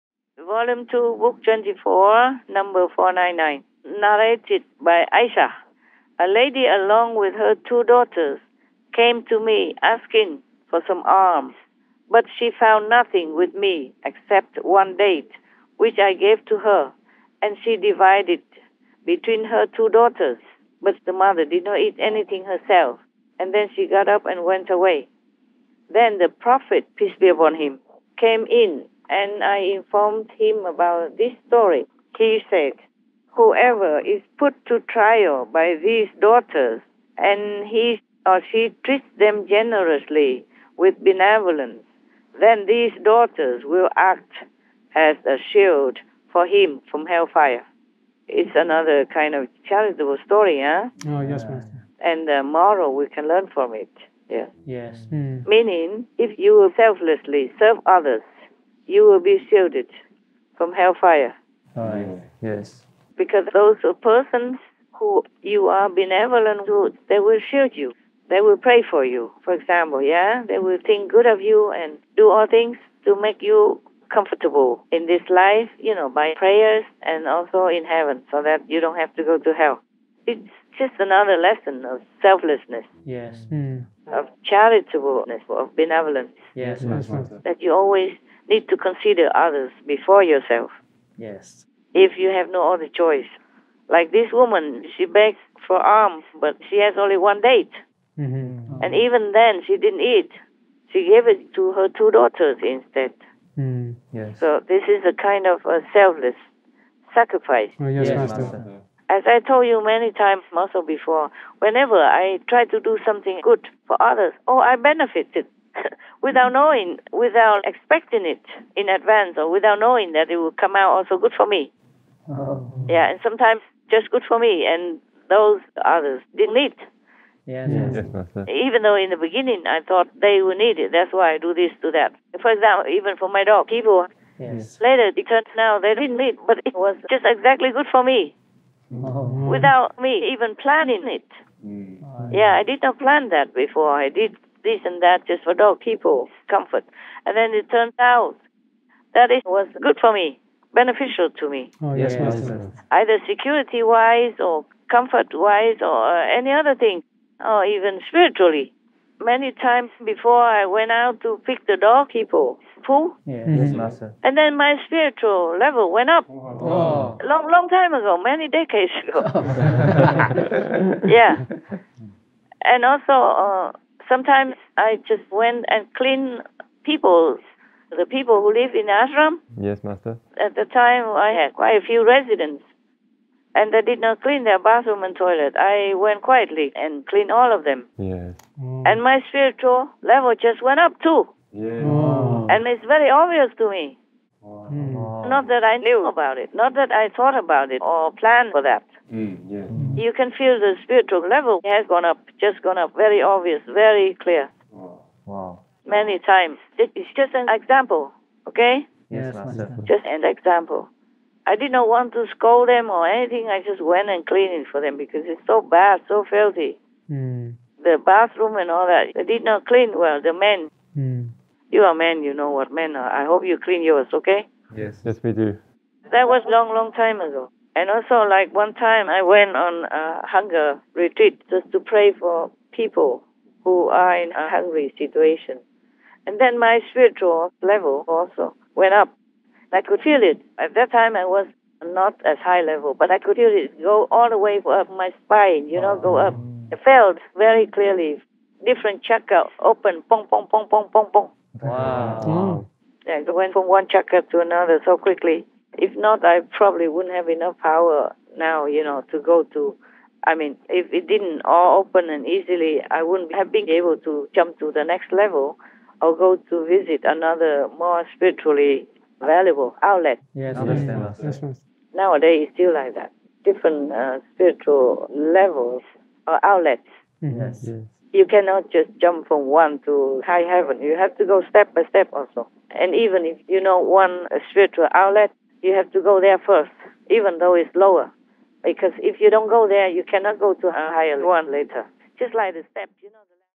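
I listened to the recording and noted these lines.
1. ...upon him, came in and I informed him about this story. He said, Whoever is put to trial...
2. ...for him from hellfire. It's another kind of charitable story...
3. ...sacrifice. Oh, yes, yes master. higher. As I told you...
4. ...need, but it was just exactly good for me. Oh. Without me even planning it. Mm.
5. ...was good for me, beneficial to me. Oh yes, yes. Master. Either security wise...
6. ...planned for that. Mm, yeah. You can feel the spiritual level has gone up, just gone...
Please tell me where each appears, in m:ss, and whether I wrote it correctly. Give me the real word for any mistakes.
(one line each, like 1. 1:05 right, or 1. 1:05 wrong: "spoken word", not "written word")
1. 0:27 right
2. 0:46 right
3. 1:47 wrong: "master", not "higher"
4. 2:16 right
5. 2:29 right
6. 3:18 right.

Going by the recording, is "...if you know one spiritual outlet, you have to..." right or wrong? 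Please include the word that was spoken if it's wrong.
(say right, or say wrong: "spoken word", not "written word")
right.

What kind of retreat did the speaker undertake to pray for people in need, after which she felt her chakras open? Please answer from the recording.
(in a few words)
Hunger retreat.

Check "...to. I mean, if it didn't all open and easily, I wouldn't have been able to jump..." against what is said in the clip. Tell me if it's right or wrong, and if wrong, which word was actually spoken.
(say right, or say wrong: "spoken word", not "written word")
right.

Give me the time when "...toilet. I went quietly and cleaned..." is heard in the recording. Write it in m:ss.
3:05.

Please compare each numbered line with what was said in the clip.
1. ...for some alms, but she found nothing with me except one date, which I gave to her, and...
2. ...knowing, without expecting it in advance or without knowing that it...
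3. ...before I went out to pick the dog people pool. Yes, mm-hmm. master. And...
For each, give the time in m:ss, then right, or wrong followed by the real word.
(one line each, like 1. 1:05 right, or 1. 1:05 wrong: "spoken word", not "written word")
1. 0:10 right
2. 1:56 right
3. 2:40 right.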